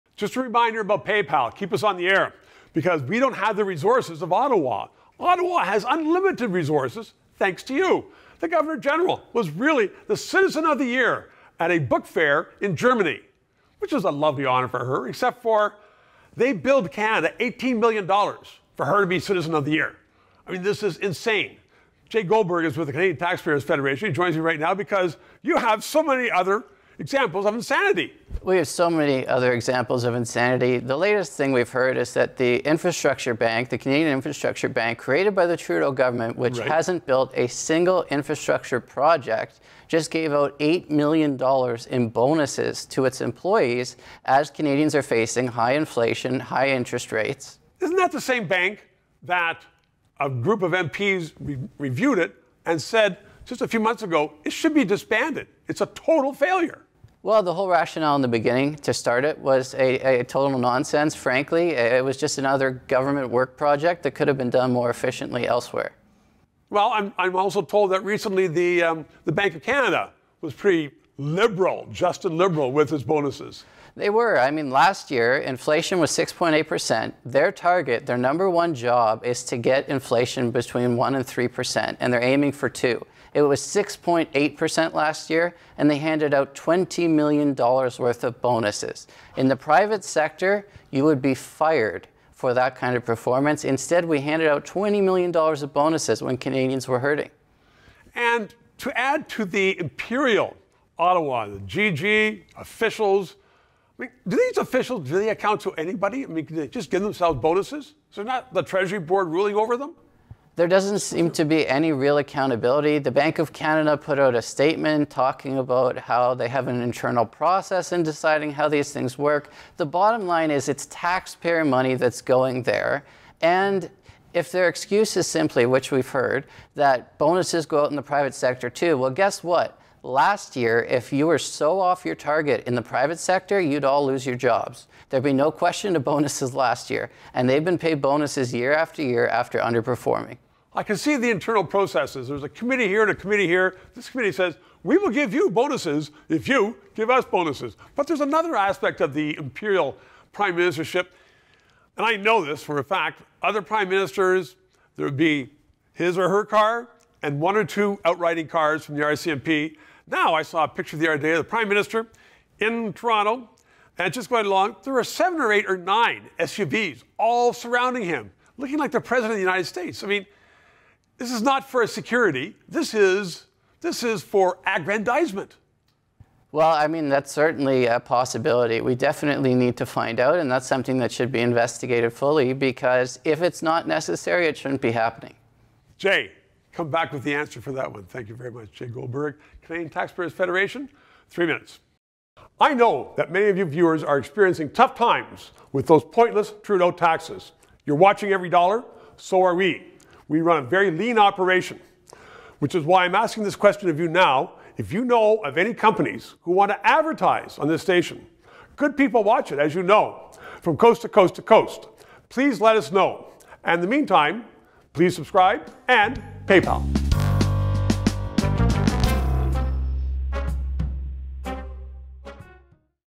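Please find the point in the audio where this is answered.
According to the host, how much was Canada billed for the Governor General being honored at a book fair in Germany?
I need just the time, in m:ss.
0:17.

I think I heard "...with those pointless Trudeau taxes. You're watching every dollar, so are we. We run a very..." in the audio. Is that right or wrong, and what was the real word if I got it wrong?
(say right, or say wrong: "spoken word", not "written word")
right.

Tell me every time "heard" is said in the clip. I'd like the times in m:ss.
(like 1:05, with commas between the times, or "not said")
0:31, 2:06.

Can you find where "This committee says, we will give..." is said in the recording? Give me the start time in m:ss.
2:23.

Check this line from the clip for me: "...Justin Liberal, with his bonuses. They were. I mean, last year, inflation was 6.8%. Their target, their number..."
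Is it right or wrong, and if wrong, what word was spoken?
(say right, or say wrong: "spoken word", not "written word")
right.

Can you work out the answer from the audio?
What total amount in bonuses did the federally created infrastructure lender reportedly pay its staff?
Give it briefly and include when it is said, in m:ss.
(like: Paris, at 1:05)
$8 million, at 0:40.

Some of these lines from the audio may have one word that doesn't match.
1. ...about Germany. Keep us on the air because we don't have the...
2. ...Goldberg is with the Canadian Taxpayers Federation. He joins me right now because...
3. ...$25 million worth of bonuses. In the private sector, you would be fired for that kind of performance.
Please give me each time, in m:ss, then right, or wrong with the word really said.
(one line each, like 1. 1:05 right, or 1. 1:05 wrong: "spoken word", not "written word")
1. 0:00 wrong: "PayPal", not "Germany"
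2. 0:22 right
3. 1:26 wrong: "20", not "25".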